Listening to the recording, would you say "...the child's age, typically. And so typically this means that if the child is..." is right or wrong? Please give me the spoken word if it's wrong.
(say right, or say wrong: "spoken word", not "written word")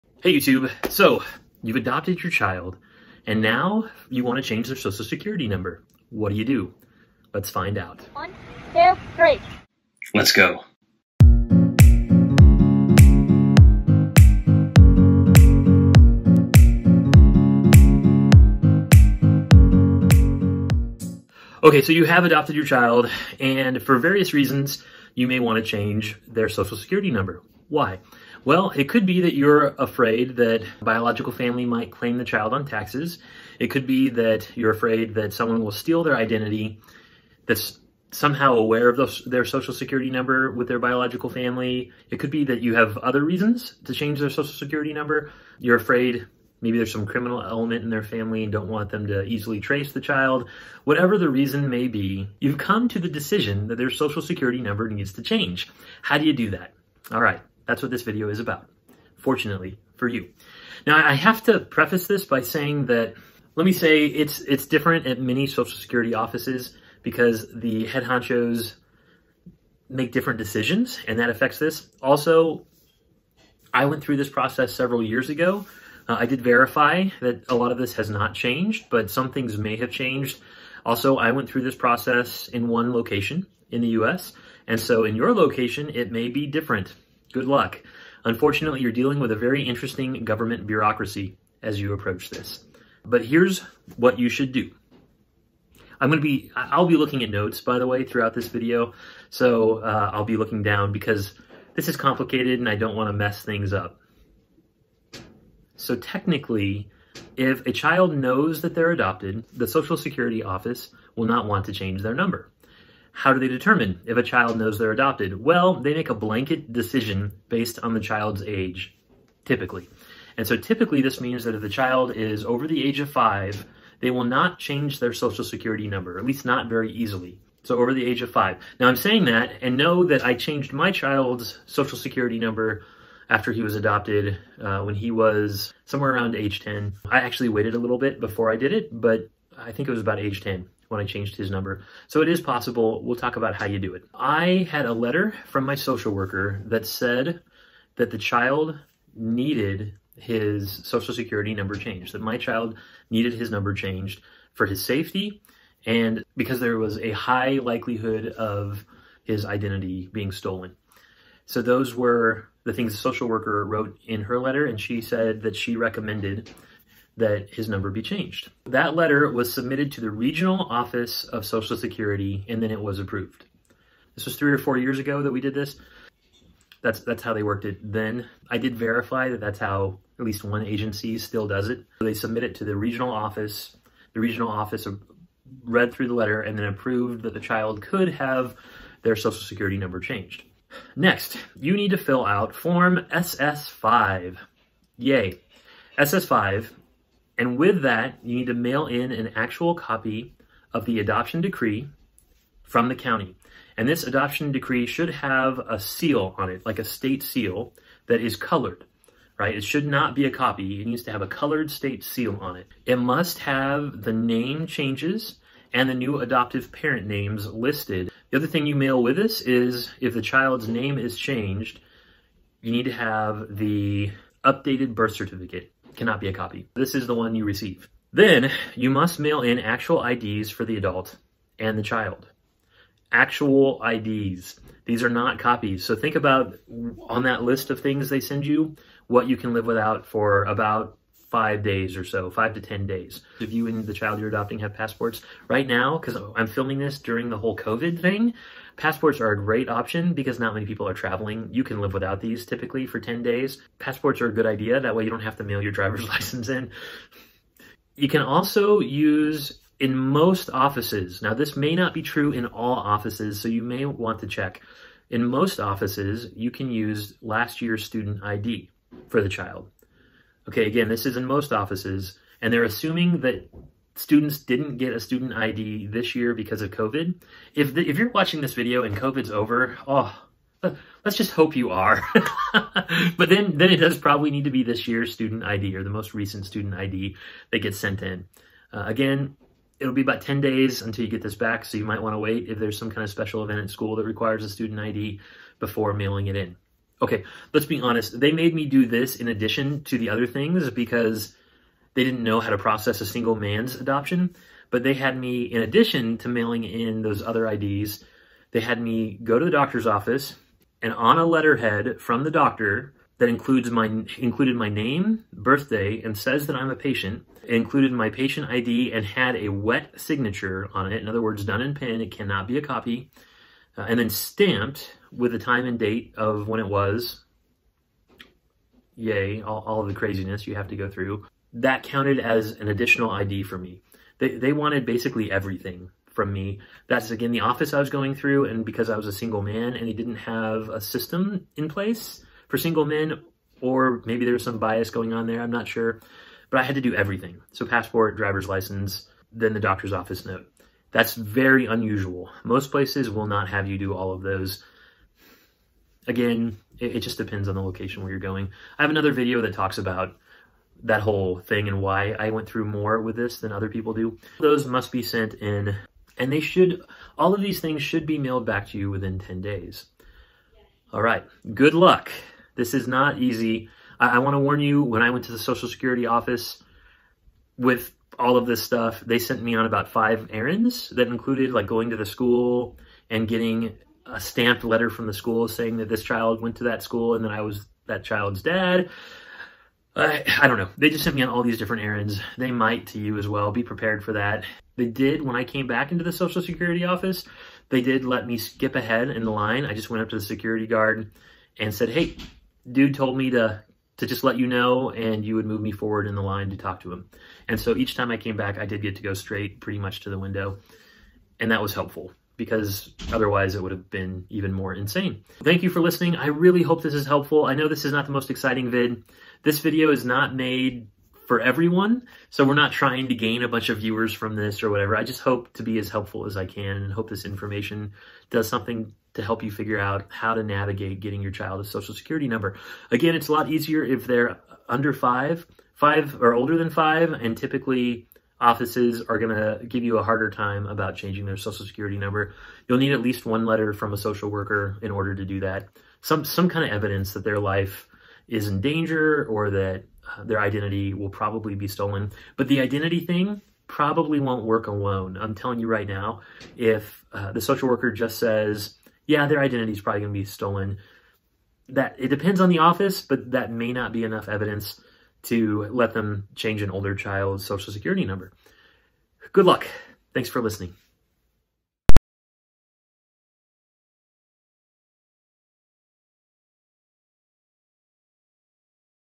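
right.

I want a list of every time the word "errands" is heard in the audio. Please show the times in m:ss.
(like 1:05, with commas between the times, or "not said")
6:20, 6:31.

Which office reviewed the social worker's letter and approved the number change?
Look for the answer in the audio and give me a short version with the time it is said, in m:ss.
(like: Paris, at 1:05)
Regional Office of Social Security, at 2:50.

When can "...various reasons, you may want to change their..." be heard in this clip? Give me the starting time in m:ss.
0:23.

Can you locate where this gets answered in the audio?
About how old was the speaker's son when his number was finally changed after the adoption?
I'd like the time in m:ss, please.
2:16.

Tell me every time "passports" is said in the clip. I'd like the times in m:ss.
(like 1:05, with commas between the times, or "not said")
4:04, 4:08, 4:13, 5:47.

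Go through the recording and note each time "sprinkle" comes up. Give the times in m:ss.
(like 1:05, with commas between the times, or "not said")
not said.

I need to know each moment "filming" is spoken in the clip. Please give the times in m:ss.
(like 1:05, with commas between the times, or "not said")
4:06.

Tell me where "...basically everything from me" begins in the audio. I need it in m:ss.
5:34.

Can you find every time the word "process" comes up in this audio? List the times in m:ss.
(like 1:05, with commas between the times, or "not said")
1:14, 1:21, 5:02.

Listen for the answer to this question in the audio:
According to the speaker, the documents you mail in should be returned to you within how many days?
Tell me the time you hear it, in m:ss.
6:08.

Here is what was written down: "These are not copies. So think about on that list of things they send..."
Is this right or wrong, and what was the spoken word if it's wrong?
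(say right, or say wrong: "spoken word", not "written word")
right.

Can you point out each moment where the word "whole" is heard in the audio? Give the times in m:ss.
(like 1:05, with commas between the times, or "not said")
4:07, 6:01.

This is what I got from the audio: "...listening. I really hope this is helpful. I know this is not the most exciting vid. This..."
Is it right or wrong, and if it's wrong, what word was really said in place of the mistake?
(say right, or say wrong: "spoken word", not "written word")
right.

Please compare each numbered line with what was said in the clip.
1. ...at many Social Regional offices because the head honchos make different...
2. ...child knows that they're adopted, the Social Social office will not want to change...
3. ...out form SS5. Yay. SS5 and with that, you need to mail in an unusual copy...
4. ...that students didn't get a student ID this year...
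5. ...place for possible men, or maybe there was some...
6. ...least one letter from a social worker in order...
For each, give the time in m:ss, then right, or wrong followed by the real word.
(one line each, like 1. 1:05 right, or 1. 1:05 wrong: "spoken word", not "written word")
1. 1:05 wrong: "Security", not "Regional"
2. 1:47 wrong: "Security", not "Social"
3. 3:12 wrong: "actual", not "unusual"
4. 4:33 right
5. 5:41 wrong: "single", not "possible"
6. 7:23 right.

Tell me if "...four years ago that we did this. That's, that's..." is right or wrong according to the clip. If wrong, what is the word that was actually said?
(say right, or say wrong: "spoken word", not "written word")
right.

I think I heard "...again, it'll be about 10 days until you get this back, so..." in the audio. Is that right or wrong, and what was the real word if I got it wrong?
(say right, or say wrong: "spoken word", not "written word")
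right.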